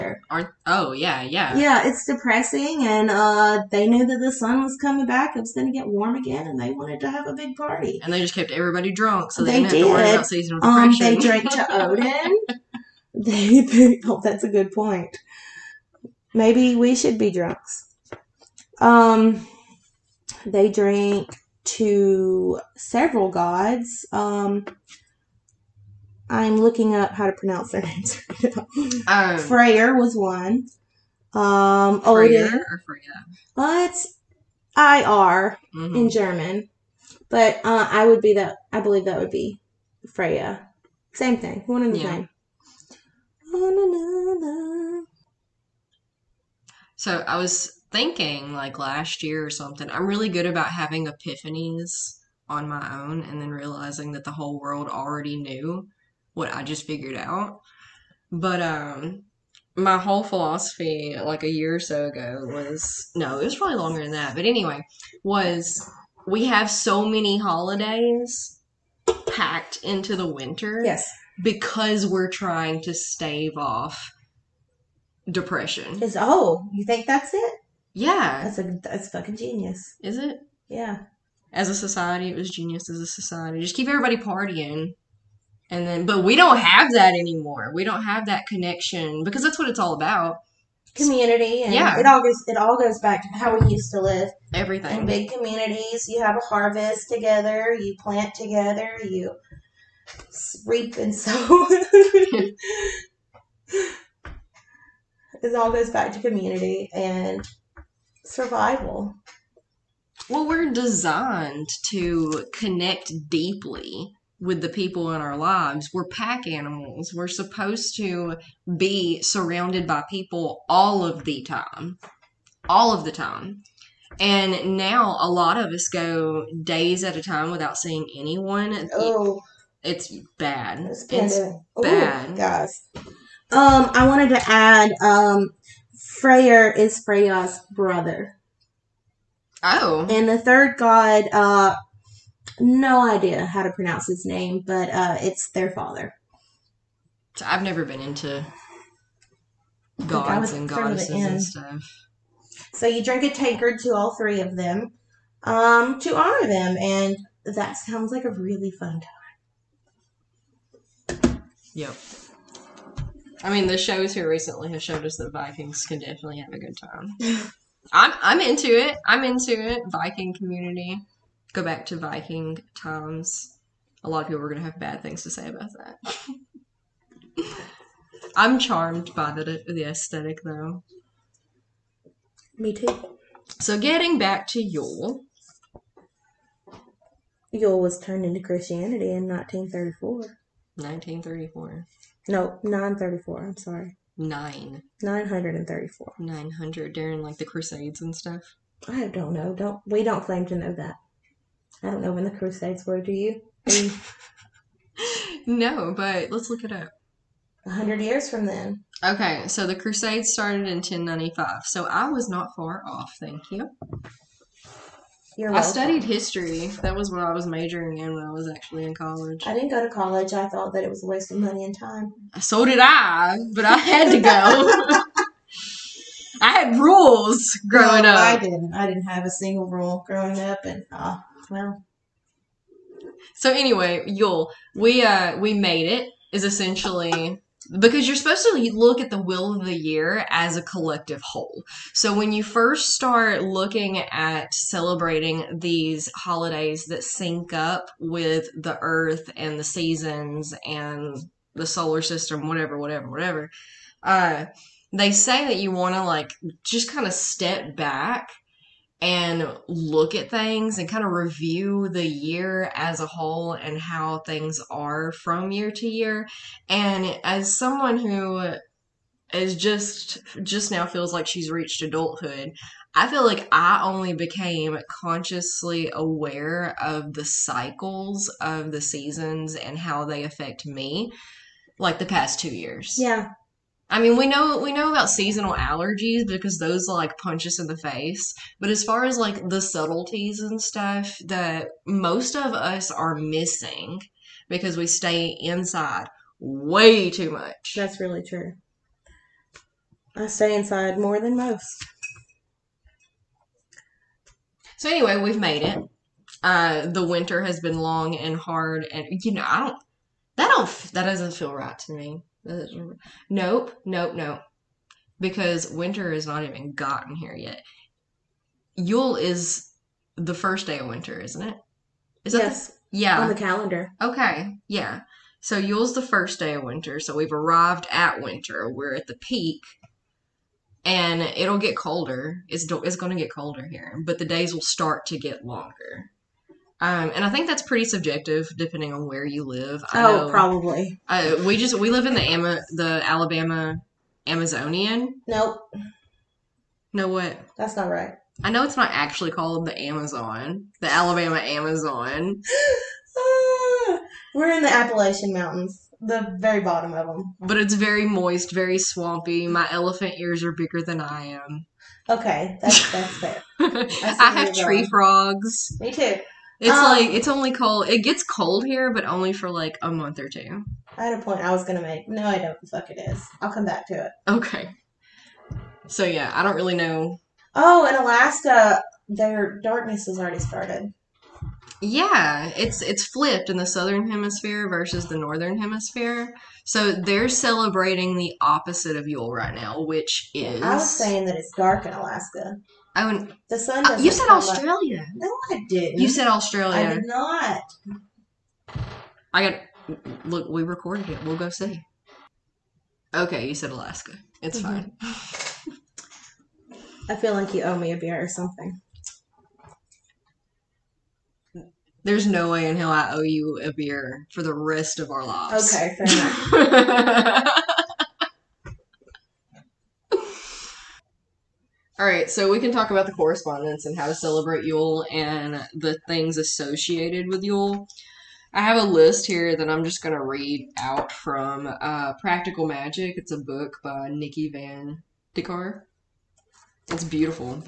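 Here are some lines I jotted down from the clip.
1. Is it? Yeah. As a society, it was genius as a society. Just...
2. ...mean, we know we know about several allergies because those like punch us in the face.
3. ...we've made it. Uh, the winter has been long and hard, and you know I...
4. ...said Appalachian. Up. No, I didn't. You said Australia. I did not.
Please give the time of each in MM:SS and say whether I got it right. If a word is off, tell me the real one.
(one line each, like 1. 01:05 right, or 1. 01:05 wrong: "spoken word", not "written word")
1. 01:20 right
2. 04:44 wrong: "seasonal", not "several"
3. 05:05 right
4. 06:34 wrong: "Australia", not "Appalachian".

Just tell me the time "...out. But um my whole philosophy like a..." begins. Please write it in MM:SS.
00:57.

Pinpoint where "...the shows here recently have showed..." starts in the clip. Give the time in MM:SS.
02:43.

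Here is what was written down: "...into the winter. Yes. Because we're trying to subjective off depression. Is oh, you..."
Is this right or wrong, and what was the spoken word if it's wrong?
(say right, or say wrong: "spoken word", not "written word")
wrong: "stave", not "subjective".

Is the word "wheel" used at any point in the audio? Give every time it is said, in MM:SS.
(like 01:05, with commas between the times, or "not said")
03:59.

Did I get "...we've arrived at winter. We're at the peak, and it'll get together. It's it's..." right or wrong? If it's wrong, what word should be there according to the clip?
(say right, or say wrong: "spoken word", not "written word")
wrong: "colder", not "together".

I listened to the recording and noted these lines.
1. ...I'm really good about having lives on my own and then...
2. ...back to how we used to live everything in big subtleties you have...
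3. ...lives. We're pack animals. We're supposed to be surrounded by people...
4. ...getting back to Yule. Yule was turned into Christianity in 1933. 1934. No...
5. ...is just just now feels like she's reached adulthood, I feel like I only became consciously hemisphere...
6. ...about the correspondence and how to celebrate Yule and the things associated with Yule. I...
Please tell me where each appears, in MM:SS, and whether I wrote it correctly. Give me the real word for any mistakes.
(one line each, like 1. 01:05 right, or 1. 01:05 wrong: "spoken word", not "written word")
1. 00:49 wrong: "epiphanies", not "lives"
2. 01:32 wrong: "communities", not "subtleties"
3. 01:55 right
4. 03:03 wrong: "1934", not "1933"
5. 04:29 wrong: "aware", not "hemisphere"
6. 07:02 right.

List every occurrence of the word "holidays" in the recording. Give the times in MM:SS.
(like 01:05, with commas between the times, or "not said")
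01:07, 04:06.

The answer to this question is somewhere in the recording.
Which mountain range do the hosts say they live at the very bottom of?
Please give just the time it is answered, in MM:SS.
05:54.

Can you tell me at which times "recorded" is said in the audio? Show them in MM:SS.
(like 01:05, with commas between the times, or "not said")
06:40.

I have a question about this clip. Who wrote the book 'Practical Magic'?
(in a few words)
Nikki Van De Car.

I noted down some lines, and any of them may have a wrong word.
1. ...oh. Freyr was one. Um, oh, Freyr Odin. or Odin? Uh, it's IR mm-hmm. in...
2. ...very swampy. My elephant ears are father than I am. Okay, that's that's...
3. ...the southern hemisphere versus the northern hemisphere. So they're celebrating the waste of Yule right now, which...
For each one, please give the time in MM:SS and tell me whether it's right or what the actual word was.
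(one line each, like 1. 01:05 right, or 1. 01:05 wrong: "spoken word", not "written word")
1. 00:29 wrong: "Freya", not "Odin"
2. 05:58 wrong: "bigger", not "father"
3. 06:23 wrong: "opposite", not "waste".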